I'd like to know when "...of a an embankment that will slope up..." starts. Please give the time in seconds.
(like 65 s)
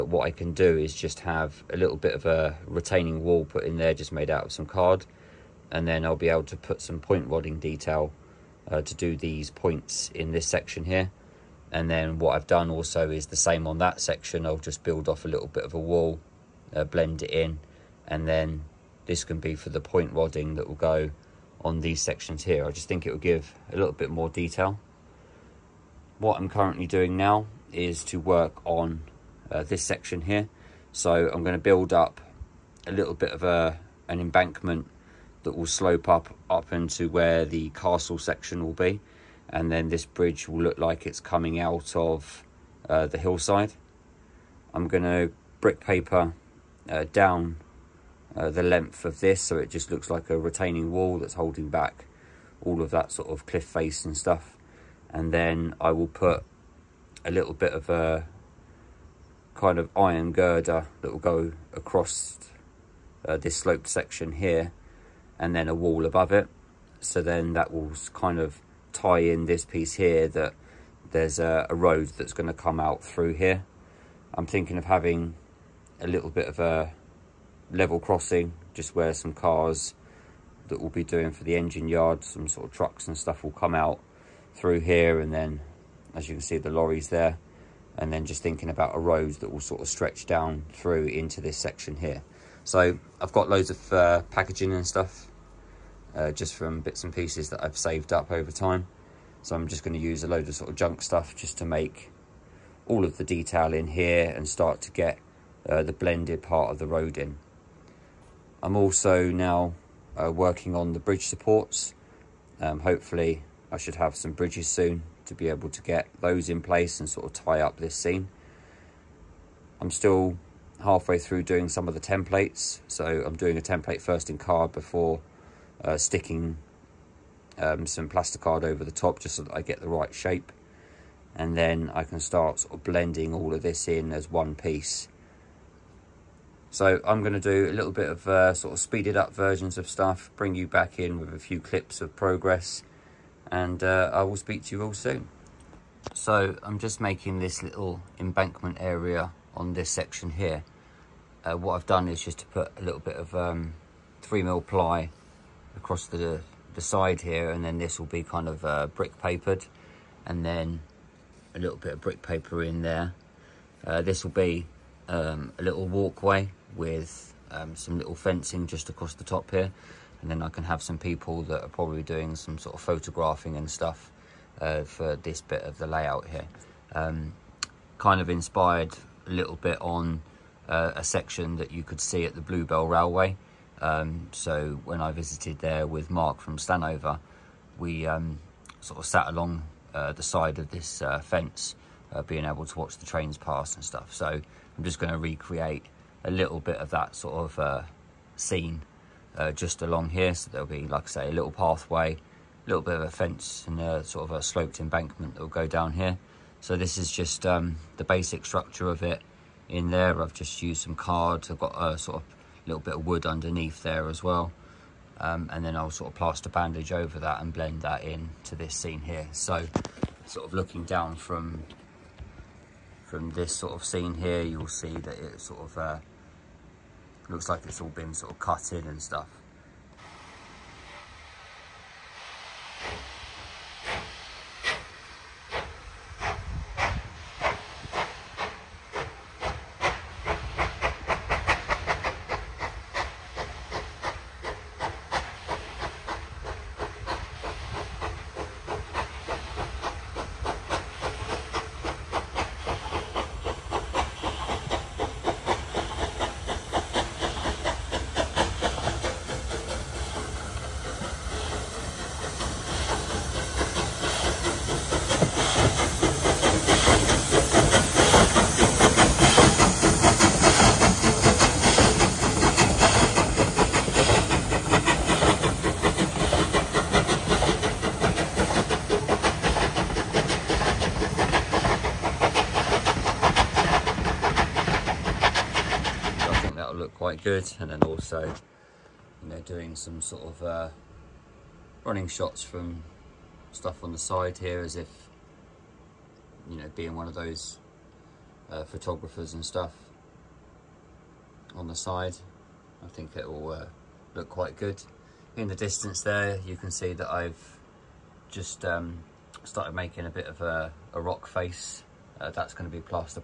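33 s.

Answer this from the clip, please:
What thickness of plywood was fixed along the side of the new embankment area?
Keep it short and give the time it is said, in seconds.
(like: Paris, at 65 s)
3 mm, at 154 s.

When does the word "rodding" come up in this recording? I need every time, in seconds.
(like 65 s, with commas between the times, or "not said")
7 s, 20 s.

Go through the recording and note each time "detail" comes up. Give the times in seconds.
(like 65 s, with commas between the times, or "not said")
7 s, 24 s, 103 s.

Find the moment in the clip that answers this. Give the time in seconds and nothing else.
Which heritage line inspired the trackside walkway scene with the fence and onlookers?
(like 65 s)
182 s.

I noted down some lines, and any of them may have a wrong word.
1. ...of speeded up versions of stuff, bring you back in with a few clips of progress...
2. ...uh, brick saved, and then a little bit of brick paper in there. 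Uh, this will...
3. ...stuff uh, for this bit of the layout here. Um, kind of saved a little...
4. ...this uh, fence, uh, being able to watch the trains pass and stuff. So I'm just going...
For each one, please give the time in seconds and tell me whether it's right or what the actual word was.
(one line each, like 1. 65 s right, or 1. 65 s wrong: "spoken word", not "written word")
1. 138 s right
2. 158 s wrong: "papered", not "saved"
3. 173 s wrong: "inspired", not "saved"
4. 190 s right.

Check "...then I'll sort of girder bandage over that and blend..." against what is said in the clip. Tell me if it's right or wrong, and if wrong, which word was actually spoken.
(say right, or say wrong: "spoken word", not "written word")
wrong: "plaster", not "girder".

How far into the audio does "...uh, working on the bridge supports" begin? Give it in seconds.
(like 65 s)
110 s.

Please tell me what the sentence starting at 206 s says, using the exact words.
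So this is just um, the basic structure of it in there.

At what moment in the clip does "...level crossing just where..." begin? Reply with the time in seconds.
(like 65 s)
77 s.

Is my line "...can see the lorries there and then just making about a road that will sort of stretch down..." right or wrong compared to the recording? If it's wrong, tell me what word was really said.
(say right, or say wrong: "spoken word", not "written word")
wrong: "thinking", not "making".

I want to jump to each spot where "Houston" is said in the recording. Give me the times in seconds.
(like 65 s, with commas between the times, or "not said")
not said.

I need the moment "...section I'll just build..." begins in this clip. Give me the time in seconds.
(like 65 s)
14 s.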